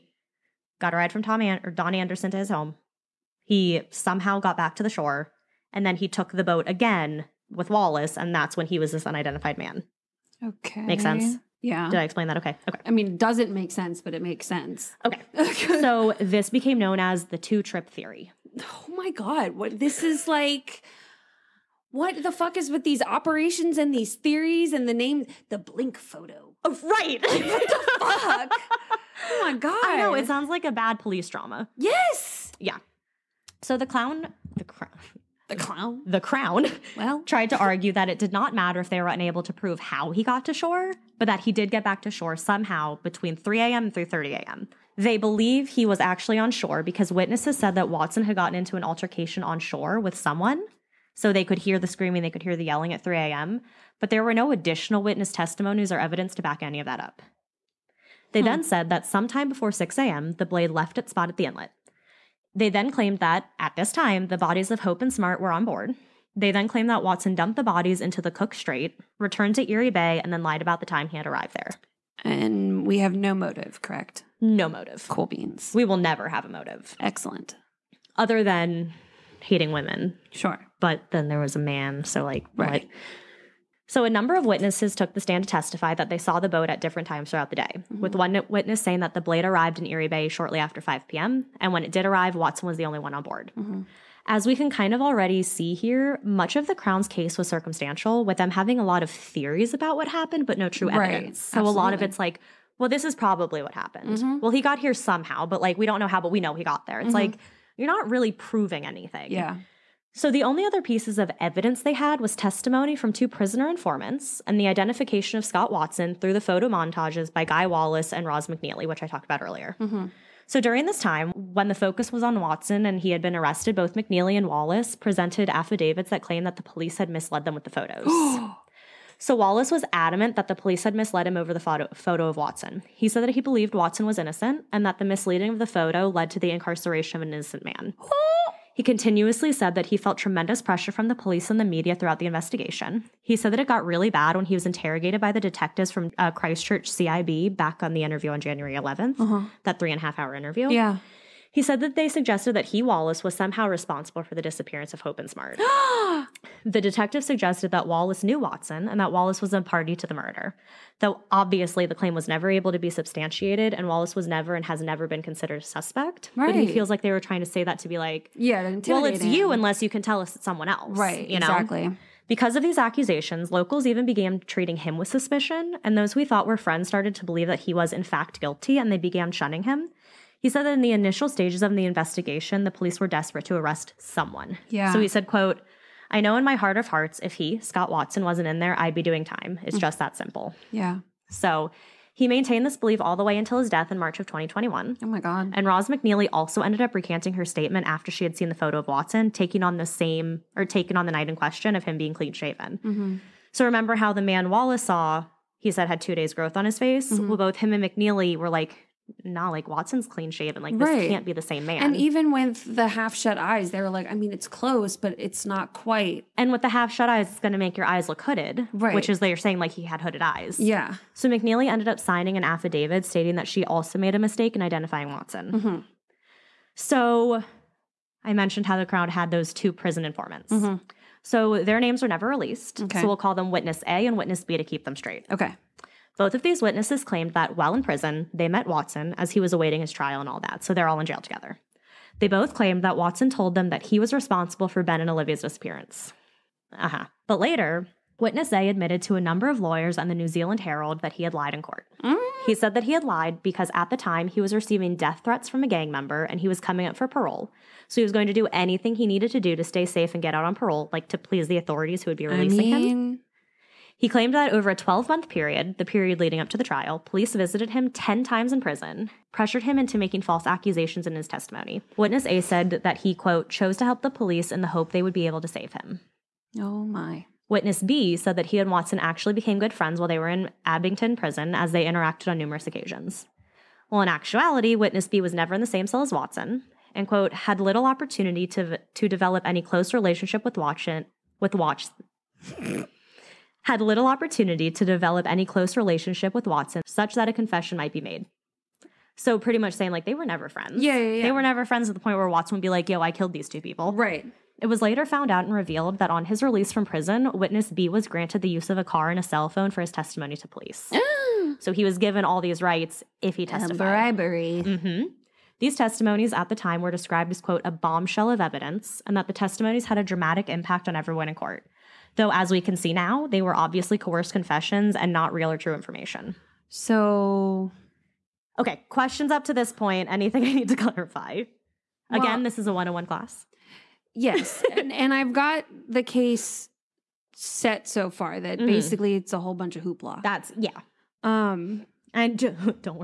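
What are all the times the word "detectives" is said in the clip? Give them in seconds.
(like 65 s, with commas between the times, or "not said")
145 s, 156 s.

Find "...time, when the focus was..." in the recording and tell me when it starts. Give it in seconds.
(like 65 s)
120 s.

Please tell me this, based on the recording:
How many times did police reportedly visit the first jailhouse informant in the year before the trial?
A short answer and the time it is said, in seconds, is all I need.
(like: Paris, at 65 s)
10, at 267 s.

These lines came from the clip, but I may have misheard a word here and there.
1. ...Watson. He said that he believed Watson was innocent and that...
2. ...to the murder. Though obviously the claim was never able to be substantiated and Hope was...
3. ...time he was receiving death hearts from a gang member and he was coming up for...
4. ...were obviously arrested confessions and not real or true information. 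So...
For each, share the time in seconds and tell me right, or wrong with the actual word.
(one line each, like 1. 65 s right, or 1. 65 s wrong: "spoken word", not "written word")
1. 132 s right
2. 159 s wrong: "Wallace", not "Hope"
3. 253 s wrong: "threats", not "hearts"
4. 323 s wrong: "coerced", not "arrested".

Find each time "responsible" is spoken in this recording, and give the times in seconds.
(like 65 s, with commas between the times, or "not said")
153 s, 244 s.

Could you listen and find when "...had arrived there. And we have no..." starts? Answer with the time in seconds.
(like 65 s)
71 s.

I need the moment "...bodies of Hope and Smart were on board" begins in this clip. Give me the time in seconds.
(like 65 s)
64 s.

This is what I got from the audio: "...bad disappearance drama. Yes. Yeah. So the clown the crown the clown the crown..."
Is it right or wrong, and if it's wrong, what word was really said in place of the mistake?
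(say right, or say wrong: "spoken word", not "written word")
wrong: "police", not "disappearance".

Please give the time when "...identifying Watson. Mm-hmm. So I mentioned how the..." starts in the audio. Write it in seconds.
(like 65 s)
224 s.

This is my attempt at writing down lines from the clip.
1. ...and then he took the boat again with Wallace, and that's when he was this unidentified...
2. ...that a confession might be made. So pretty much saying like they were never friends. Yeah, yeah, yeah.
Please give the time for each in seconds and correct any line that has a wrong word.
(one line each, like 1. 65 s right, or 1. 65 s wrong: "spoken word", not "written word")
1. 5 s right
2. 297 s right.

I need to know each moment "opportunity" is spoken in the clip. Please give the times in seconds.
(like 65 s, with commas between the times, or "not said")
287 s, 294 s.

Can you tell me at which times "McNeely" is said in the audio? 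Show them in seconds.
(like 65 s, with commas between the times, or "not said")
118 s, 123 s, 195 s, 207 s, 221 s.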